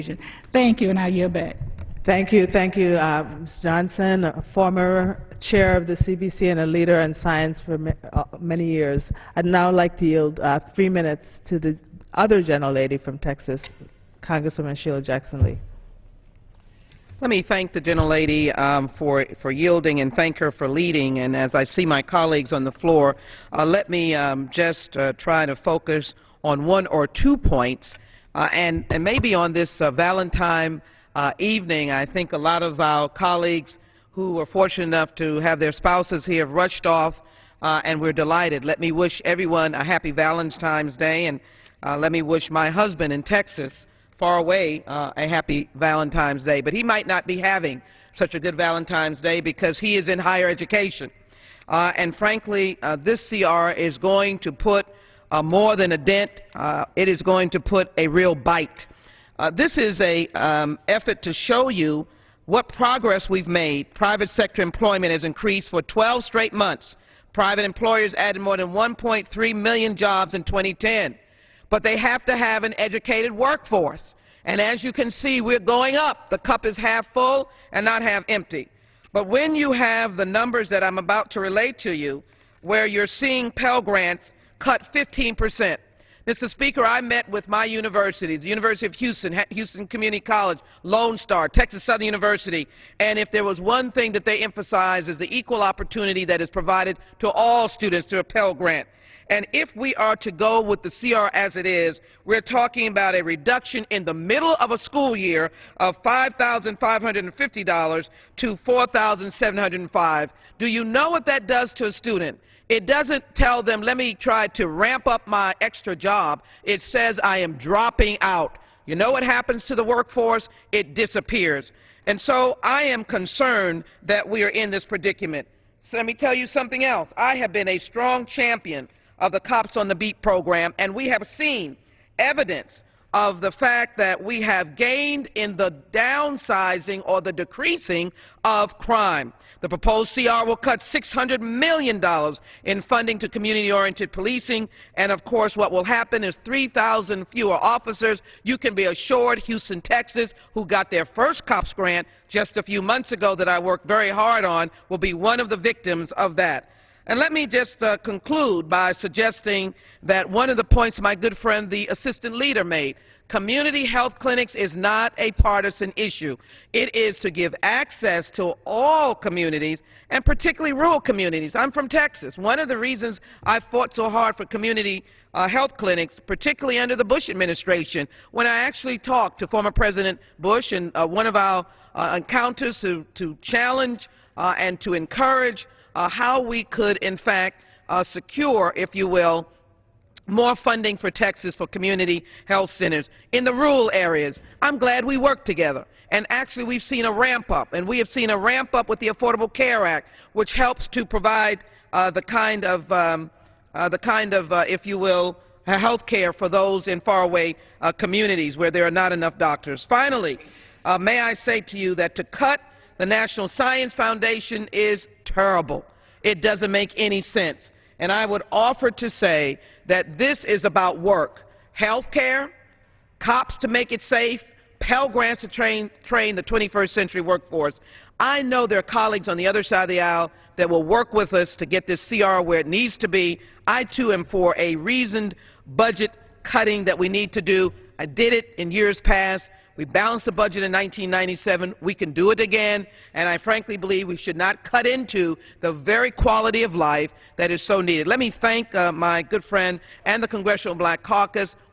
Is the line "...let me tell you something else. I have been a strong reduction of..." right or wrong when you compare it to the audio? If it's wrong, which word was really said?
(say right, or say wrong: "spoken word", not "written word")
wrong: "champion", not "reduction".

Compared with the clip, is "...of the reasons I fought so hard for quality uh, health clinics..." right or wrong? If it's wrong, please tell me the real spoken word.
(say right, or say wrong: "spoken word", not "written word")
wrong: "community", not "quality".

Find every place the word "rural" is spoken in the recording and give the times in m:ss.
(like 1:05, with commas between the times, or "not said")
2:50, 3:13.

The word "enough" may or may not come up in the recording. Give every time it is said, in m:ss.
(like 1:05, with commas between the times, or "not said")
0:34, 3:29.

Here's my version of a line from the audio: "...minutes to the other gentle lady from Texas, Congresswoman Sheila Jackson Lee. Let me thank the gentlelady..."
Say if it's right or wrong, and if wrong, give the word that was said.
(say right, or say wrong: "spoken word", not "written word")
right.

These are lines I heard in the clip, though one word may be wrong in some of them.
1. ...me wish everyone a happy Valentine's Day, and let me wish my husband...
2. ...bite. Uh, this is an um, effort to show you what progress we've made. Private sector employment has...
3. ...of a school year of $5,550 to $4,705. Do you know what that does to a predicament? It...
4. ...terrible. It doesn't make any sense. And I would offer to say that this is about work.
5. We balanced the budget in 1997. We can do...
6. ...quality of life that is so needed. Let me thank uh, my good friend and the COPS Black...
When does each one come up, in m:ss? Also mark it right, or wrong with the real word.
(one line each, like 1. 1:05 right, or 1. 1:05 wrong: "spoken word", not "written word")
1. 0:38 right
2. 0:58 right
3. 1:44 wrong: "student", not "predicament"
4. 3:35 right
5. 3:59 right
6. 4:06 wrong: "Congressional", not "COPS".